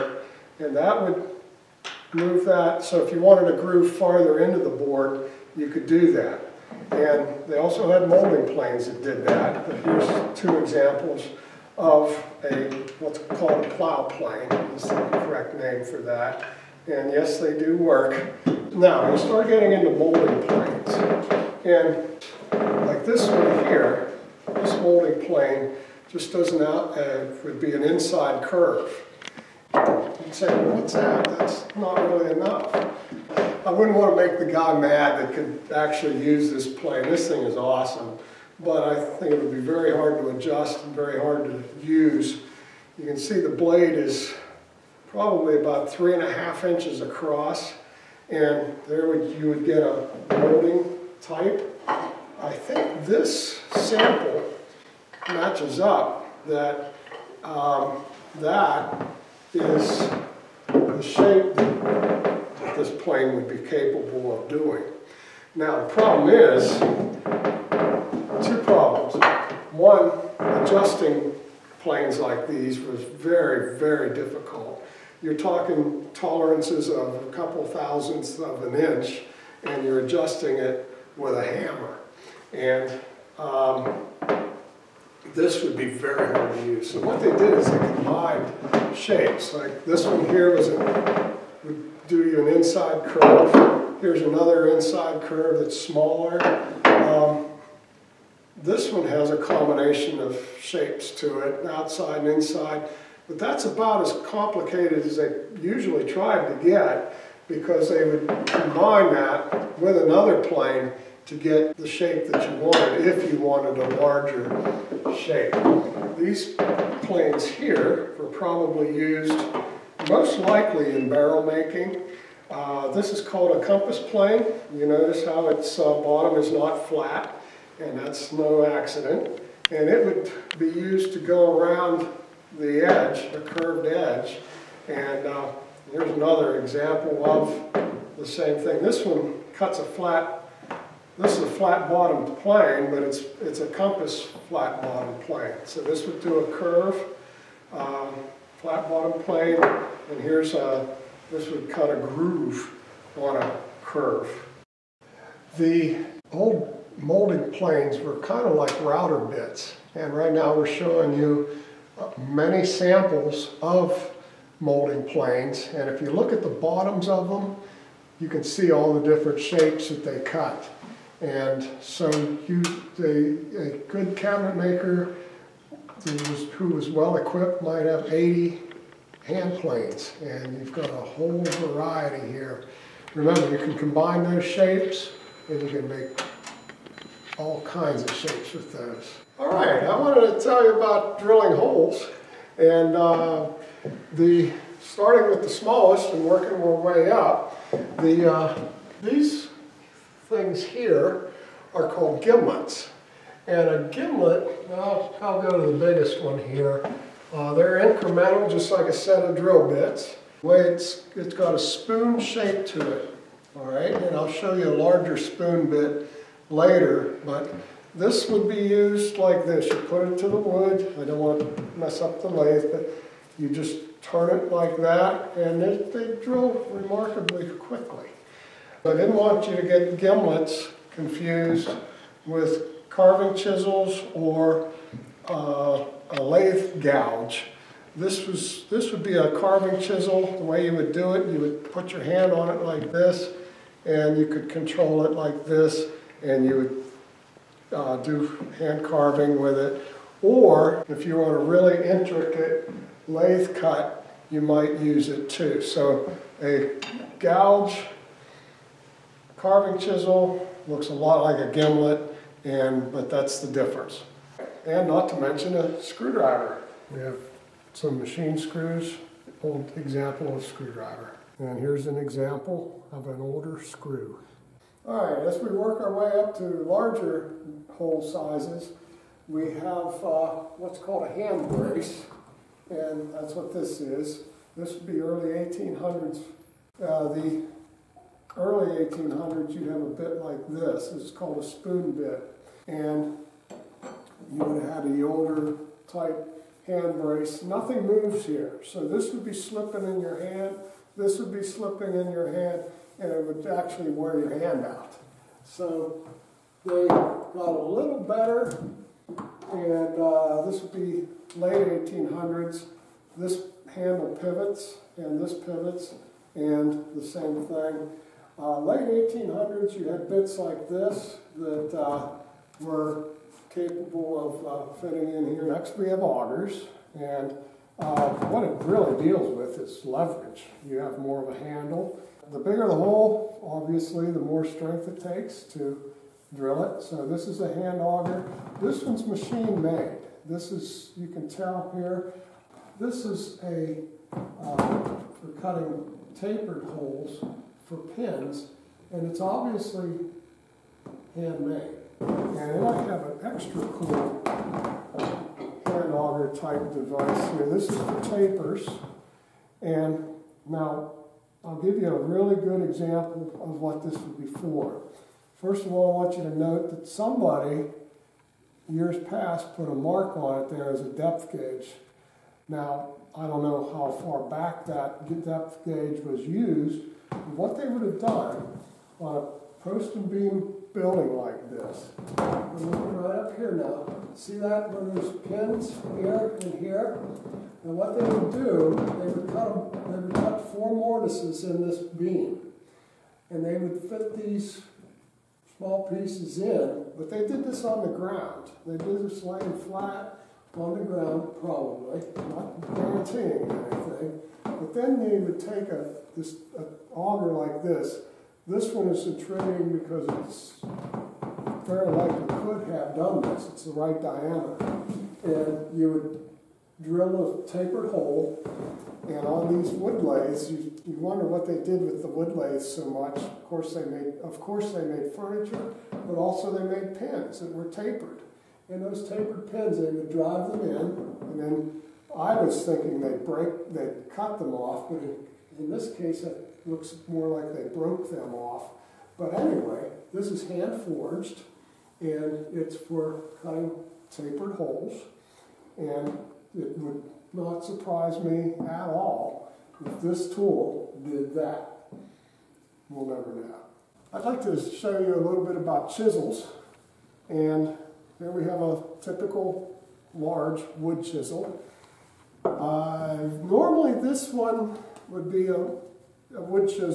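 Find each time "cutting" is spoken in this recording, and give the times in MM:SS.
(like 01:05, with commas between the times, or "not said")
05:45, 07:23.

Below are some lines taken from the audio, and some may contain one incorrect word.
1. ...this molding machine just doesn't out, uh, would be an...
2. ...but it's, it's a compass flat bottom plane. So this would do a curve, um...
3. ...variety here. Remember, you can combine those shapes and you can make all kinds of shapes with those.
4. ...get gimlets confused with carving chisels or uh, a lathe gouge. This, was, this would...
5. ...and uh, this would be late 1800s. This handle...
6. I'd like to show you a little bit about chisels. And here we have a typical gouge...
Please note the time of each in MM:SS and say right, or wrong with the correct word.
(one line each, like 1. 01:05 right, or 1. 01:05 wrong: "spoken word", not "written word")
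1. 00:24 wrong: "plane", not "machine"
2. 02:22 right
3. 03:01 right
4. 03:49 right
5. 05:09 right
6. 07:34 wrong: "large", not "gouge".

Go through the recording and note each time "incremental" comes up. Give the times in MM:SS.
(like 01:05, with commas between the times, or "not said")
03:27.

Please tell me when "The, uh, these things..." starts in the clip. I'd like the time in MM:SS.
03:18.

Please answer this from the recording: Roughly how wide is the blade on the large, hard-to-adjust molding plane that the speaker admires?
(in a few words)
3.5 inches.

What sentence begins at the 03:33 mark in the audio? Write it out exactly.
All right, and I'll show you a larger spoon bit later, but this would be used like this.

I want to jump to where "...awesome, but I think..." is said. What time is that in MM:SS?
00:37.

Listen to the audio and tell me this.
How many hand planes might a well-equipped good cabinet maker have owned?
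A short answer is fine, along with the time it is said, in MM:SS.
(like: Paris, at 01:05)
80, at 02:58.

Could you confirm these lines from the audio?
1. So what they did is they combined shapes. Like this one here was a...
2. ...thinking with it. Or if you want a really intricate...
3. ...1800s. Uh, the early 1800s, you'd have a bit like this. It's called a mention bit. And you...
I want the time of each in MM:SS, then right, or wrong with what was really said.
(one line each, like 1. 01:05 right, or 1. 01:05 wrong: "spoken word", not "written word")
1. 01:26 right
2. 04:08 wrong: "carving", not "thinking"
3. 04:45 wrong: "spoon", not "mention".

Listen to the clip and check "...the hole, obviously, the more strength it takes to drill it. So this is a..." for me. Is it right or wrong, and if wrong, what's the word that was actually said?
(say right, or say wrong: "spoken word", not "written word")
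right.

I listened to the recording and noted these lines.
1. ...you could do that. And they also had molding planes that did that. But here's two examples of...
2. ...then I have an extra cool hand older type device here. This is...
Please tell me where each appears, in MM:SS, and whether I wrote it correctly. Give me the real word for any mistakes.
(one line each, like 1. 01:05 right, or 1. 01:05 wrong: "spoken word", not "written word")
1. 00:05 right
2. 05:52 wrong: "auger", not "older".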